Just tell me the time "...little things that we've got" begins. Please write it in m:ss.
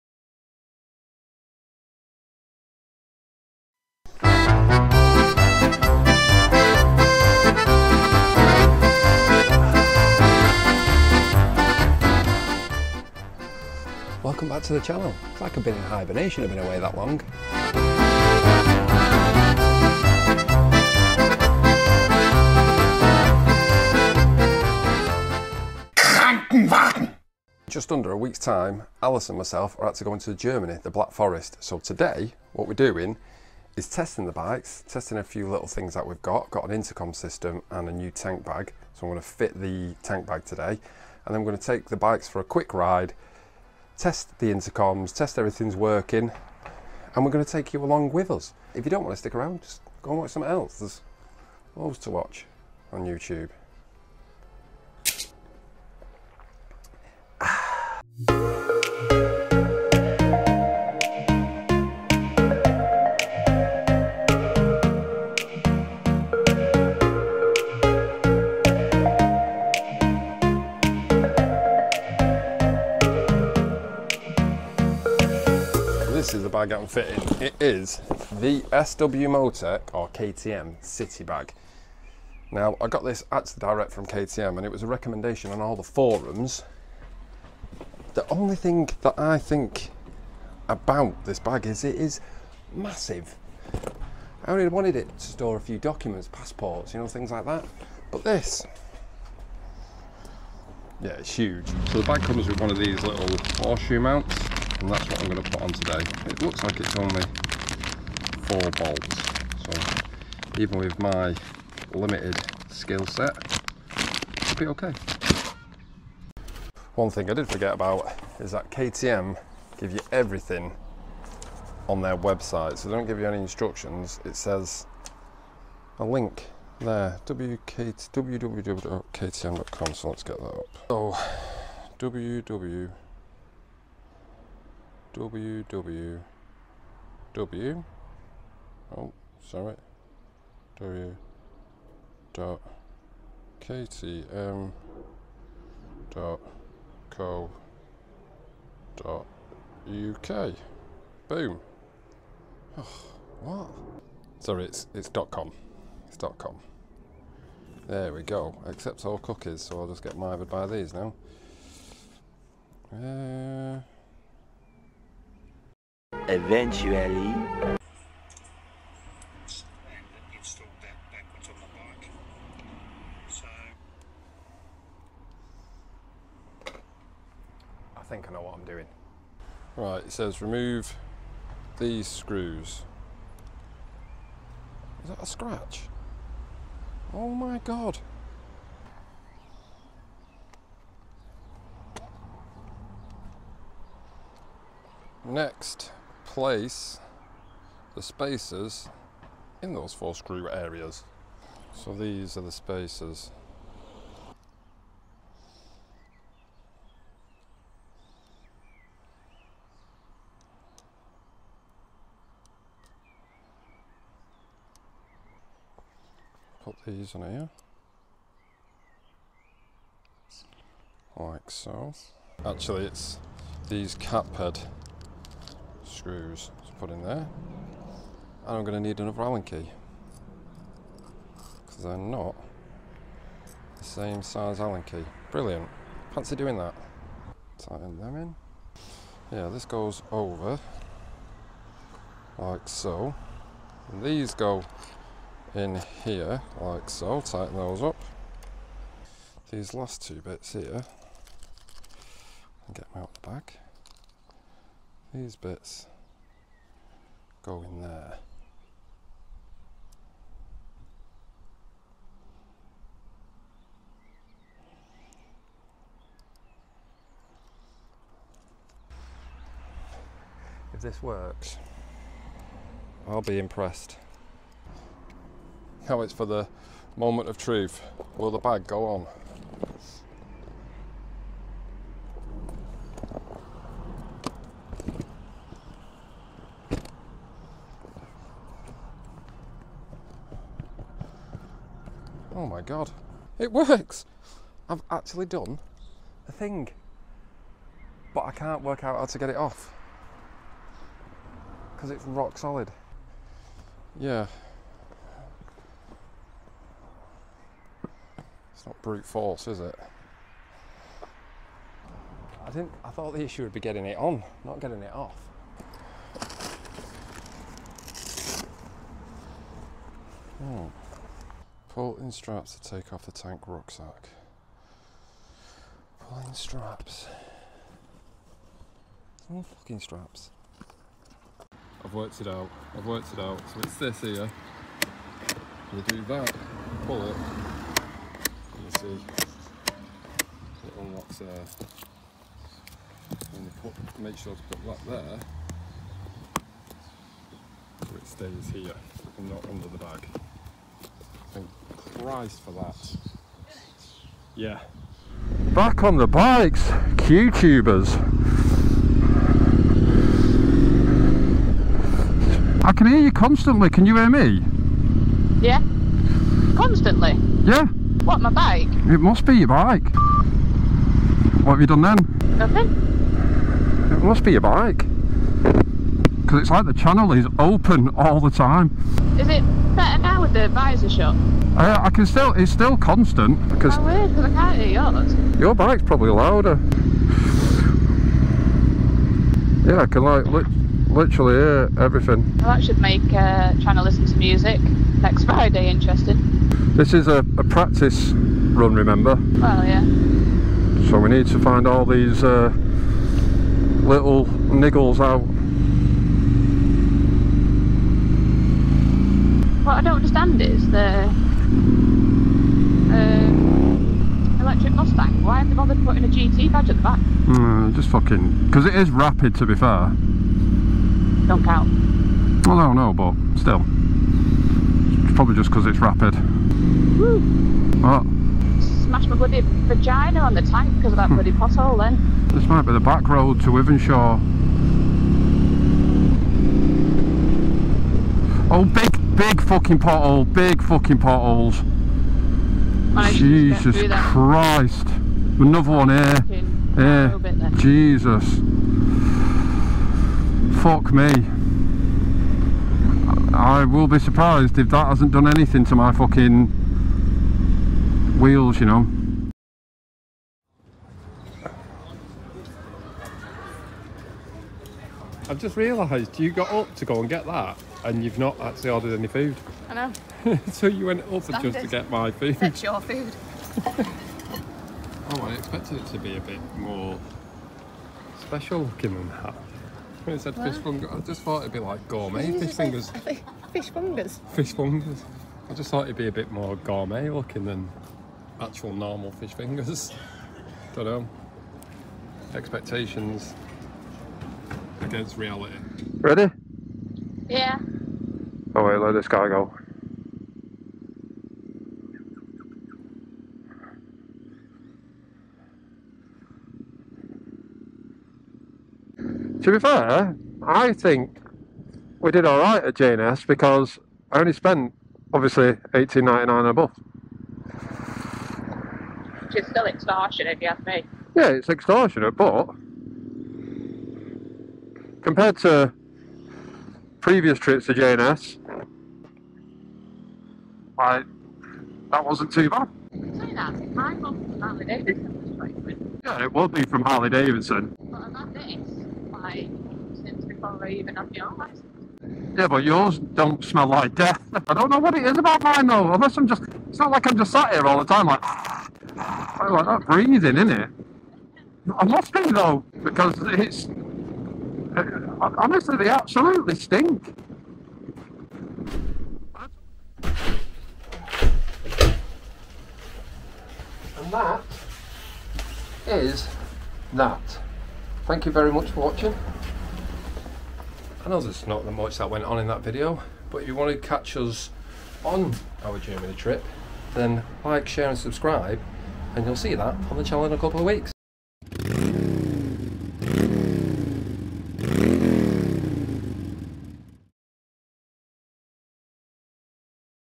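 0:35.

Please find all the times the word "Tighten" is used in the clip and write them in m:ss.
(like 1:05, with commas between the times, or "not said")
3:57, 4:07.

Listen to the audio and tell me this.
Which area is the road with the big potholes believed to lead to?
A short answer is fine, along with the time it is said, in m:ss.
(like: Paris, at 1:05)
Wythenshawe, at 7:13.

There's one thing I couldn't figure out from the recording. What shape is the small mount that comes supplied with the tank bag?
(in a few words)
horseshoe.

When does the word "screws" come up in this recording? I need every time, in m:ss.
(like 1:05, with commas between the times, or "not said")
3:02, 3:20, 3:46.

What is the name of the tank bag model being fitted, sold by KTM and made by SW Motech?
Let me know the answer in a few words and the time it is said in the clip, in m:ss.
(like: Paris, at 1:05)
City Bag, at 1:20.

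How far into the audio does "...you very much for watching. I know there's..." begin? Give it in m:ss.
9:28.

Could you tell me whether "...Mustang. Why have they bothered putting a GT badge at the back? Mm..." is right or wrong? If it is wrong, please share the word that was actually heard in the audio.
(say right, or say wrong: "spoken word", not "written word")
right.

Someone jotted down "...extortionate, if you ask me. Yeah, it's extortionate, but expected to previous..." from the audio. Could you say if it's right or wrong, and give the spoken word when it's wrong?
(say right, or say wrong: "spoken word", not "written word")
wrong: "compared", not "expected".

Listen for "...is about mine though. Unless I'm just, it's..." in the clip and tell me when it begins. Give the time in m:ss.
9:05.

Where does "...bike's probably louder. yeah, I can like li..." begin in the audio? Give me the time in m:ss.
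6:25.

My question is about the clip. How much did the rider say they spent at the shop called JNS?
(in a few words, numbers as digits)
18.99.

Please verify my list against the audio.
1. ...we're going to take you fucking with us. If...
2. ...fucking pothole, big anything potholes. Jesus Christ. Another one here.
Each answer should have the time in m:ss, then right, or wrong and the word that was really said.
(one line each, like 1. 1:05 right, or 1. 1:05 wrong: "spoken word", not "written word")
1. 0:47 wrong: "along", not "fucking"
2. 7:19 wrong: "fucking", not "anything".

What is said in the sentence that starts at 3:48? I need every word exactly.
And I'm going to need another Allen key.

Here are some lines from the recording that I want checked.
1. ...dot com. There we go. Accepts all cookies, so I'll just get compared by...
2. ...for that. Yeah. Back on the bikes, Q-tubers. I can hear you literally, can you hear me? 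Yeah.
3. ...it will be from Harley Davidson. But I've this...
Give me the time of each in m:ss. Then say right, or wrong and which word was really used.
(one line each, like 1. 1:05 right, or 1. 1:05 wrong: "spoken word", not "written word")
1. 2:36 wrong: "mired", not "compared"
2. 5:52 wrong: "constantly", not "literally"
3. 8:56 right.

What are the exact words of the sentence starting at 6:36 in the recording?
This is a, a practice run, remember?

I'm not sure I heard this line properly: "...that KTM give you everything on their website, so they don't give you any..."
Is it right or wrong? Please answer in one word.
right.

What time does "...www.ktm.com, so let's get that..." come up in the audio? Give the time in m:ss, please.
2:07.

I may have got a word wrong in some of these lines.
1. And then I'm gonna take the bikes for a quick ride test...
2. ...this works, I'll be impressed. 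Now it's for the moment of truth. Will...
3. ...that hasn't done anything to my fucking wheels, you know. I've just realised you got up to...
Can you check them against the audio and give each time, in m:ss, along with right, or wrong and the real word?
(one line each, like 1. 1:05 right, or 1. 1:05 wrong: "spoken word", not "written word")
1. 0:41 right
2. 4:30 right
3. 7:34 right.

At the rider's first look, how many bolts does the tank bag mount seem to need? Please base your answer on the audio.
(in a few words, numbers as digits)
4.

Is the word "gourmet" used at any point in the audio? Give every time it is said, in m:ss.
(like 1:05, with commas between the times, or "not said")
8:01, 8:06.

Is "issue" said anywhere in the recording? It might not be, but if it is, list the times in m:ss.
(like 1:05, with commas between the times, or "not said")
5:13.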